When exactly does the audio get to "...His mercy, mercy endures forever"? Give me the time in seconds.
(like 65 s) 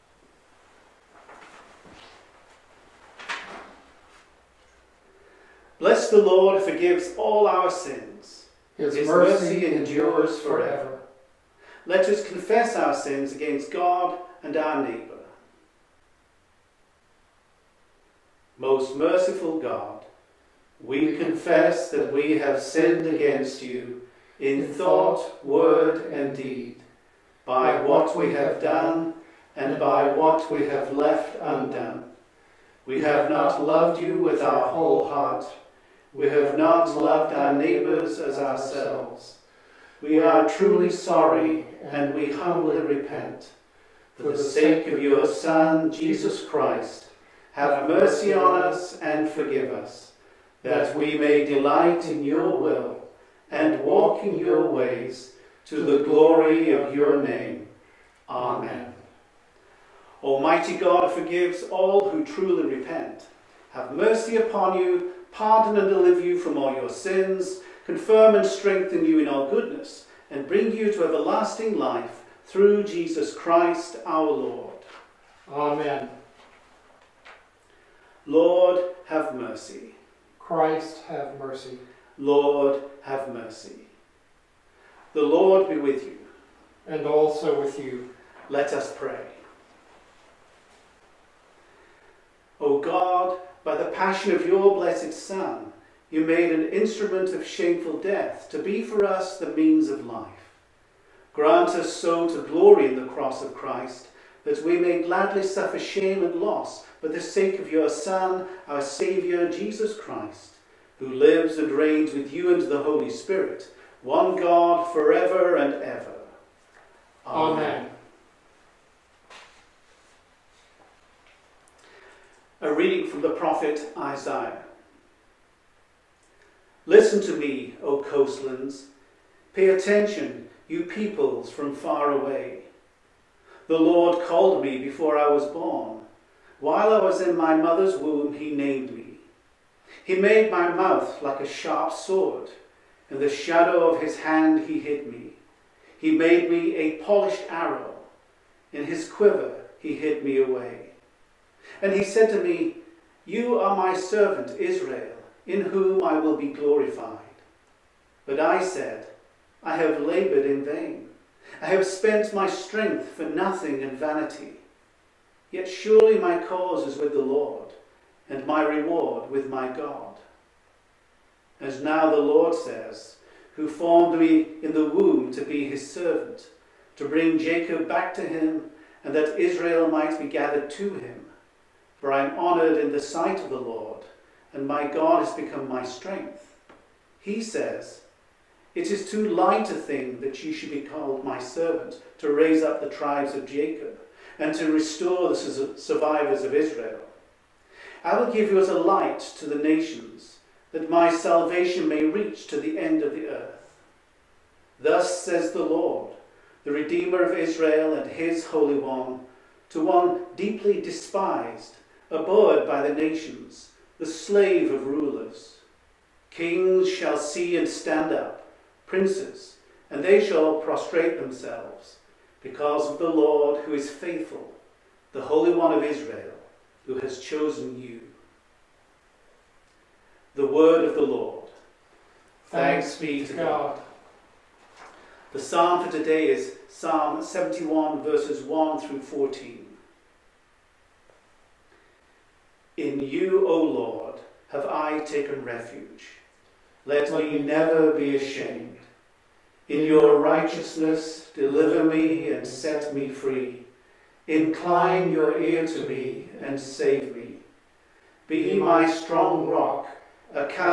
8 s.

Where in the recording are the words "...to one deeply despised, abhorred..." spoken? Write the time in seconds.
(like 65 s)
209 s.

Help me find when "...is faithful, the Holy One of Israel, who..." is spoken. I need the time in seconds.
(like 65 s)
223 s.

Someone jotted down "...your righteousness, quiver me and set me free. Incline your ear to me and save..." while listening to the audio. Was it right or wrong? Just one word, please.
wrong.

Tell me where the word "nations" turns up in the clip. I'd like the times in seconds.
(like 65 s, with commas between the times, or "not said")
199 s, 212 s.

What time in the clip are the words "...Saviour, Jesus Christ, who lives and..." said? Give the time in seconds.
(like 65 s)
108 s.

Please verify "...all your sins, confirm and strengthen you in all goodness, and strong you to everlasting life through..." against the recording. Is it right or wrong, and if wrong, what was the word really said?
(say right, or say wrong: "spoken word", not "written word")
wrong: "bring", not "strong".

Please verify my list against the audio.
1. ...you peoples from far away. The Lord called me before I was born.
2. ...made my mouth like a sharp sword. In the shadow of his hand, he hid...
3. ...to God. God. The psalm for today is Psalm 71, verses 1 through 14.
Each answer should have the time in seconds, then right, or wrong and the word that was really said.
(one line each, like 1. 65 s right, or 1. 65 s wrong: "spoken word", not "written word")
1. 130 s right
2. 140 s right
3. 233 s right.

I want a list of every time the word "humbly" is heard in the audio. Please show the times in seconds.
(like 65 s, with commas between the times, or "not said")
42 s.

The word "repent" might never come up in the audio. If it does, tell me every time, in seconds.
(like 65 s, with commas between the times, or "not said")
42 s, 62 s.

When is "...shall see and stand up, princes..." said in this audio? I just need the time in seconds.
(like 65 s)
216 s.